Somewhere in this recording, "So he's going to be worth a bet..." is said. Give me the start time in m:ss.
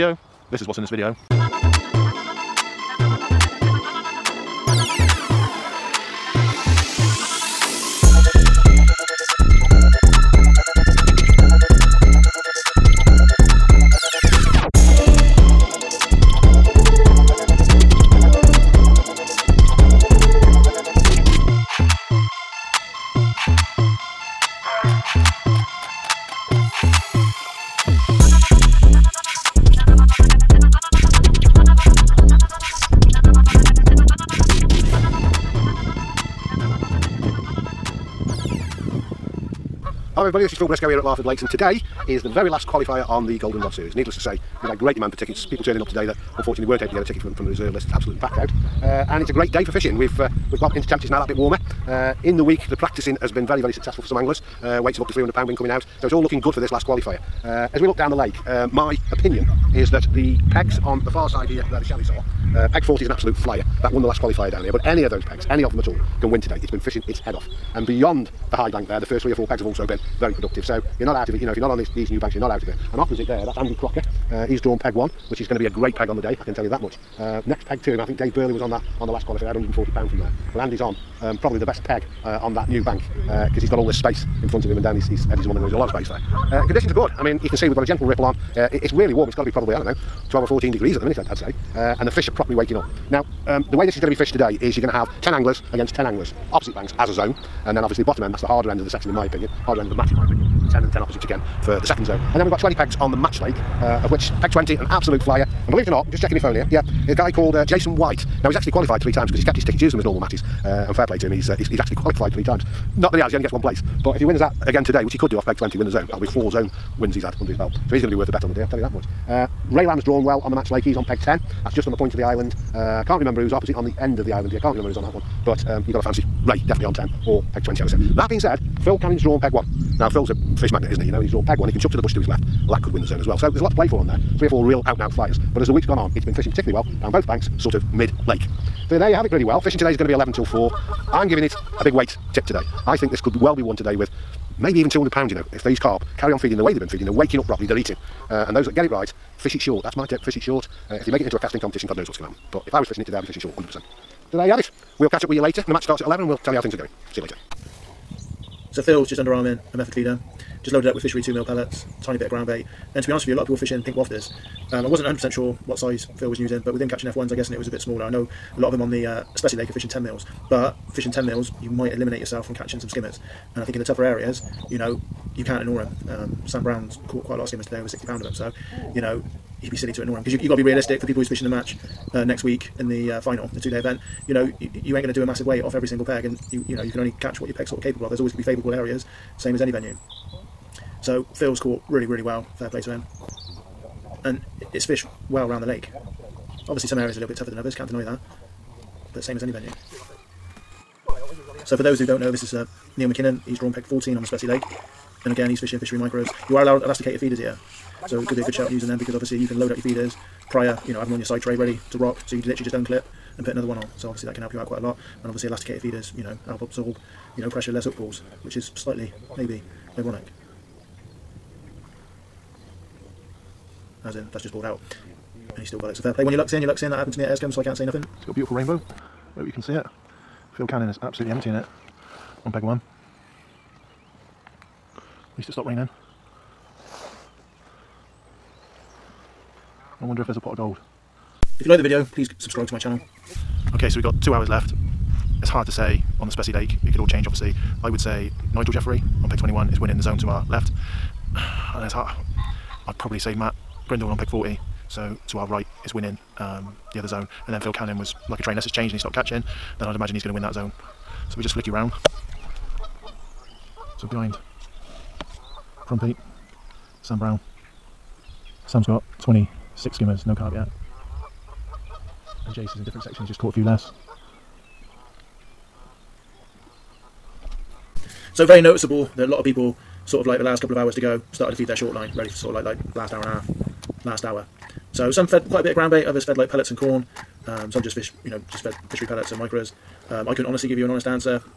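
1:57.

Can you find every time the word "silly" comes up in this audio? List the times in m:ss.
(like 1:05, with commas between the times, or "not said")
2:59.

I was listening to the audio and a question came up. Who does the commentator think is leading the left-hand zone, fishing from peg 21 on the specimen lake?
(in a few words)
Nigel Jeffrey.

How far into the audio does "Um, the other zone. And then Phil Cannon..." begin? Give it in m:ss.
4:16.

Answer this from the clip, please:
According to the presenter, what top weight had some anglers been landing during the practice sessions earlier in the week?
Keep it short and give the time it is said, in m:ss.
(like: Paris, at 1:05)
300 pounds, at 0:55.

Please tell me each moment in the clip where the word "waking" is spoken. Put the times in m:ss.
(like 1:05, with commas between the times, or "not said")
1:32, 2:27.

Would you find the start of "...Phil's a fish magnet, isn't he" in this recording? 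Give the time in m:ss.
2:10.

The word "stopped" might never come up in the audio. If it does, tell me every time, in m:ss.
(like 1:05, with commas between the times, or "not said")
3:55, 4:18.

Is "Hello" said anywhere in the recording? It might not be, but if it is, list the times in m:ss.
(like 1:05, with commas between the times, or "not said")
0:40.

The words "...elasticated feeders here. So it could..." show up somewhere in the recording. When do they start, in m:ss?
3:26.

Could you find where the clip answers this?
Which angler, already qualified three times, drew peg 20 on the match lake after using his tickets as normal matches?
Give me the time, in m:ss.
1:47.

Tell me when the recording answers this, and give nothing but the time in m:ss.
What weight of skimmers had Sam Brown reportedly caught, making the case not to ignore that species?
2:57.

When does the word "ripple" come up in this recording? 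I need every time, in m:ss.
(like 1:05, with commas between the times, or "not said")
1:28.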